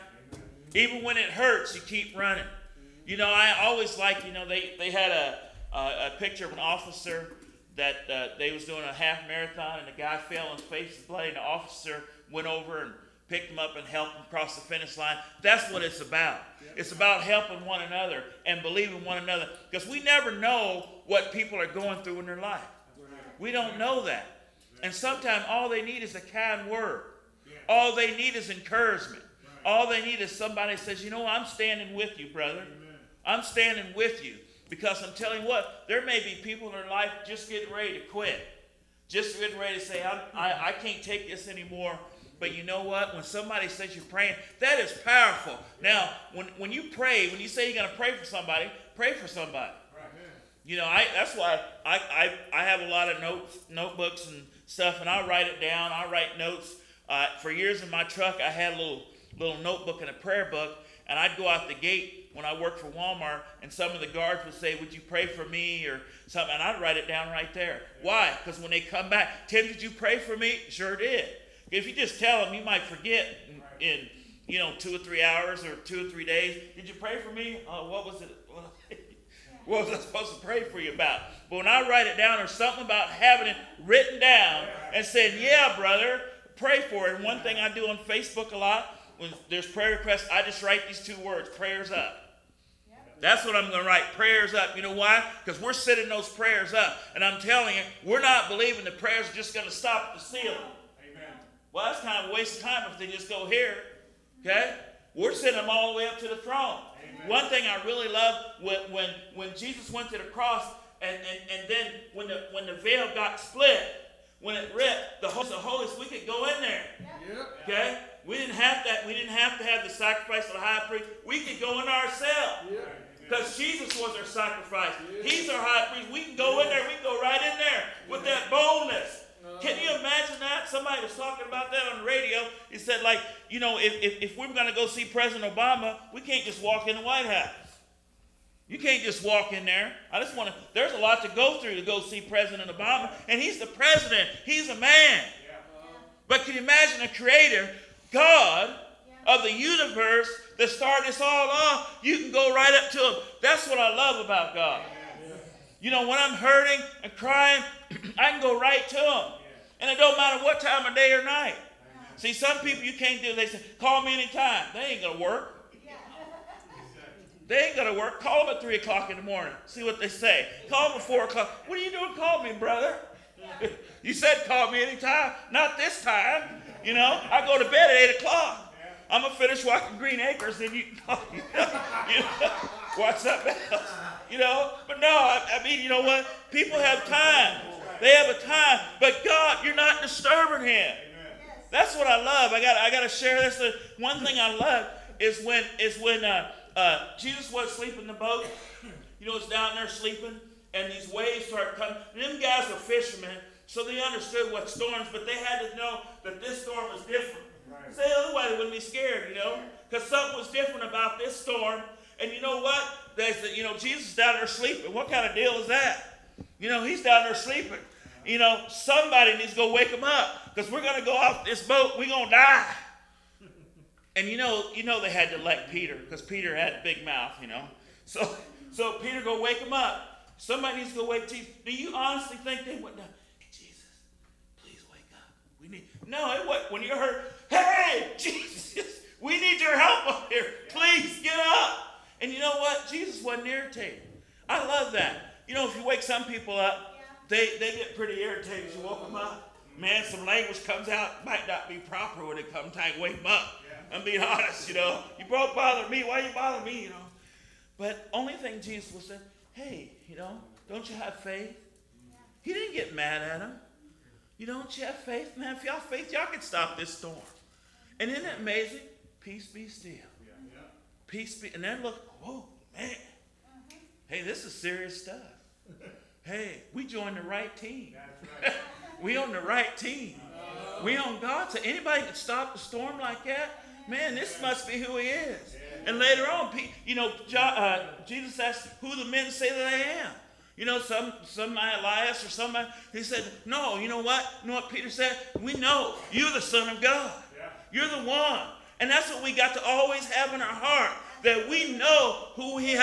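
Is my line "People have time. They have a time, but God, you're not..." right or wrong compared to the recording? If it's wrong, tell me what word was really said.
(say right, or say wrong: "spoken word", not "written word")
right.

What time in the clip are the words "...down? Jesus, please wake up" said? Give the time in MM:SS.
03:52.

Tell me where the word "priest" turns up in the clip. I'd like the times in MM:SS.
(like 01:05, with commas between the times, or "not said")
02:00, 02:05.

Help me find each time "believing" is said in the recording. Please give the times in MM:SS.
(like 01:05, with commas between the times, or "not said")
00:18, 01:38.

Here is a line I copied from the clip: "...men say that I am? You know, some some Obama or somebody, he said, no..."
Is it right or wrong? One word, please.
wrong.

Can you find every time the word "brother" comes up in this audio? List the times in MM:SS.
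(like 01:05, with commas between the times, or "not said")
00:32, 01:25, 02:52.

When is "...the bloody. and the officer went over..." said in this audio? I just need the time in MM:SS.
00:11.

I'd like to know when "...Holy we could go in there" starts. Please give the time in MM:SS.
01:55.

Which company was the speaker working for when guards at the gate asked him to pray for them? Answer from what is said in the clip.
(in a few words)
Walmart.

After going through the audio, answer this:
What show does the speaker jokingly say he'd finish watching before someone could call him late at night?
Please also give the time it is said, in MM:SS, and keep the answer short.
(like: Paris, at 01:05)
Green Acres, at 02:59.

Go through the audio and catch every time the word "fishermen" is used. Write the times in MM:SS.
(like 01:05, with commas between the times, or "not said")
03:22.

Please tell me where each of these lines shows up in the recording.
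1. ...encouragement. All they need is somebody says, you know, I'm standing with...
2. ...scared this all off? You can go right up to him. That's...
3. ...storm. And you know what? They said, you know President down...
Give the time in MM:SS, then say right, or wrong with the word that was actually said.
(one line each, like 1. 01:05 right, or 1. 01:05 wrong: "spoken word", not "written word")
1. 00:28 right
2. 02:30 wrong: "started", not "scared"
3. 03:31 wrong: "Jesus", not "President".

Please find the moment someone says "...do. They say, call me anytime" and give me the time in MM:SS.
02:43.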